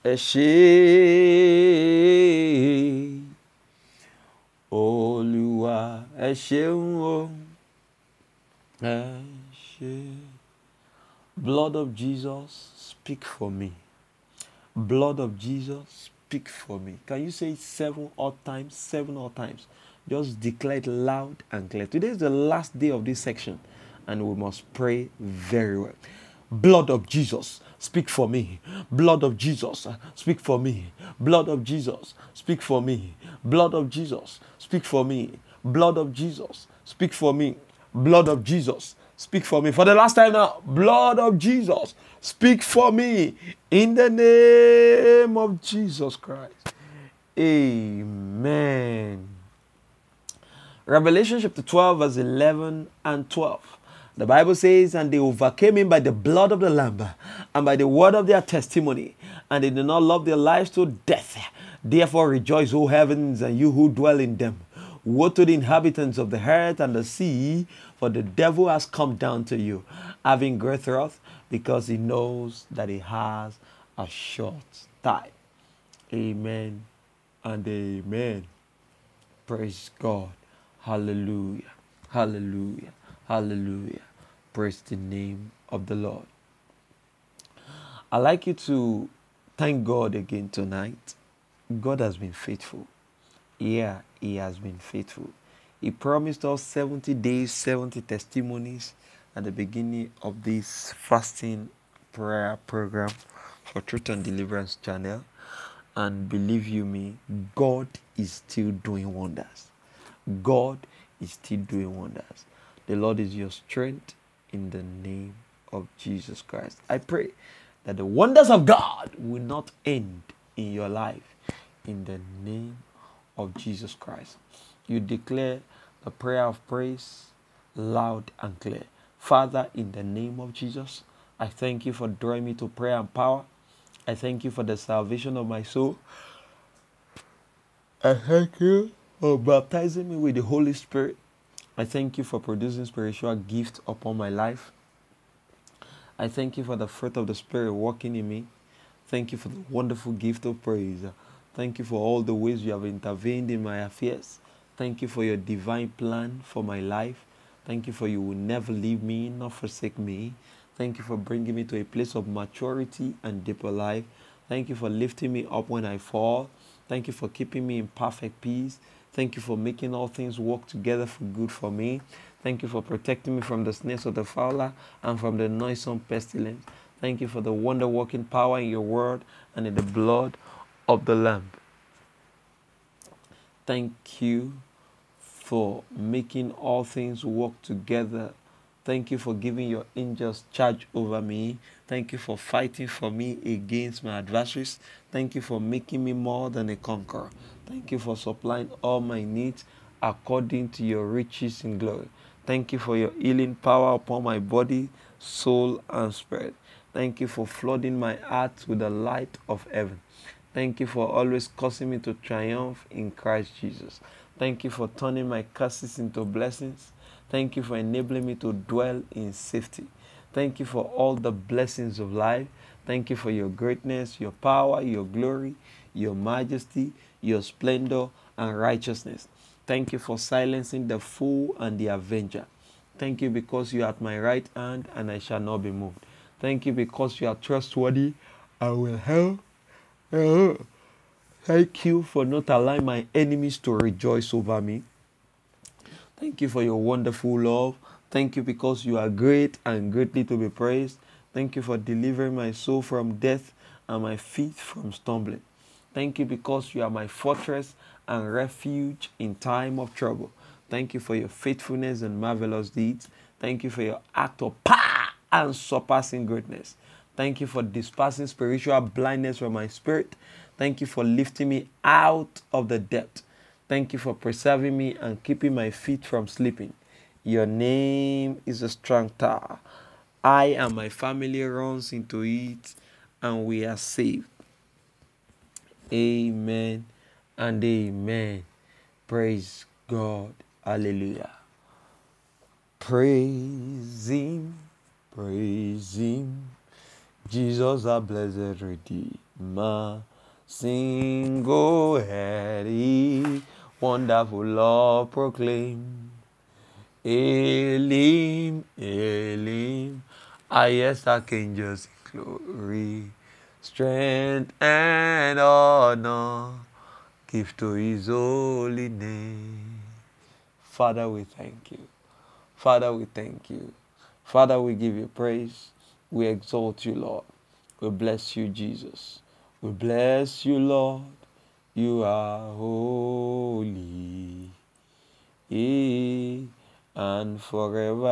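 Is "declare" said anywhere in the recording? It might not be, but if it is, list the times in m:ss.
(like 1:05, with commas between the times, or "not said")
0:20, 2:04.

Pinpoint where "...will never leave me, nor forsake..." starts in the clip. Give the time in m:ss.
2:38.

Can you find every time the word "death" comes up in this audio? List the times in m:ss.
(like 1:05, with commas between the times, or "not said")
1:01, 4:13.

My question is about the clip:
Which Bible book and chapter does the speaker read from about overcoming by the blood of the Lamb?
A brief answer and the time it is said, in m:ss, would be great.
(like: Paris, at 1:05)
Revelation chapter 12, at 0:50.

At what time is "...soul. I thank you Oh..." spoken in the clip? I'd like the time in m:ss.
2:15.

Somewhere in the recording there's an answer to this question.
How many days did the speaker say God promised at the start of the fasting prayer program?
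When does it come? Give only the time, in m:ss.
1:36.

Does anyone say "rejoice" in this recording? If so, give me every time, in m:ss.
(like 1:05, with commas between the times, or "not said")
1:02, 4:03.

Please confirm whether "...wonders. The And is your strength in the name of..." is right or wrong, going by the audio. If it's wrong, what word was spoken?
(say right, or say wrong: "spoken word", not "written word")
wrong: "Lord", not "And".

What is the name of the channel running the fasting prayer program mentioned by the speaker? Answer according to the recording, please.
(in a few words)
Truth and Deliverance.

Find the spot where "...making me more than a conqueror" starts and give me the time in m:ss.
3:15.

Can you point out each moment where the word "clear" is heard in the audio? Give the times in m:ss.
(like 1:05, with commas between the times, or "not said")
0:21, 2:08.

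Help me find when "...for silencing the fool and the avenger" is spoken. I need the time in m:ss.
3:49.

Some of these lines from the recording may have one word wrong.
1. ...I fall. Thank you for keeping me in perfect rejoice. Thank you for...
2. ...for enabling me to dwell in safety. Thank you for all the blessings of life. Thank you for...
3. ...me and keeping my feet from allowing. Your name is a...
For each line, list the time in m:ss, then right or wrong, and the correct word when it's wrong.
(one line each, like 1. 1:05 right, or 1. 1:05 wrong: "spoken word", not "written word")
1. 2:45 wrong: "peace", not "rejoice"
2. 3:37 right
3. 4:34 wrong: "slipping", not "allowing".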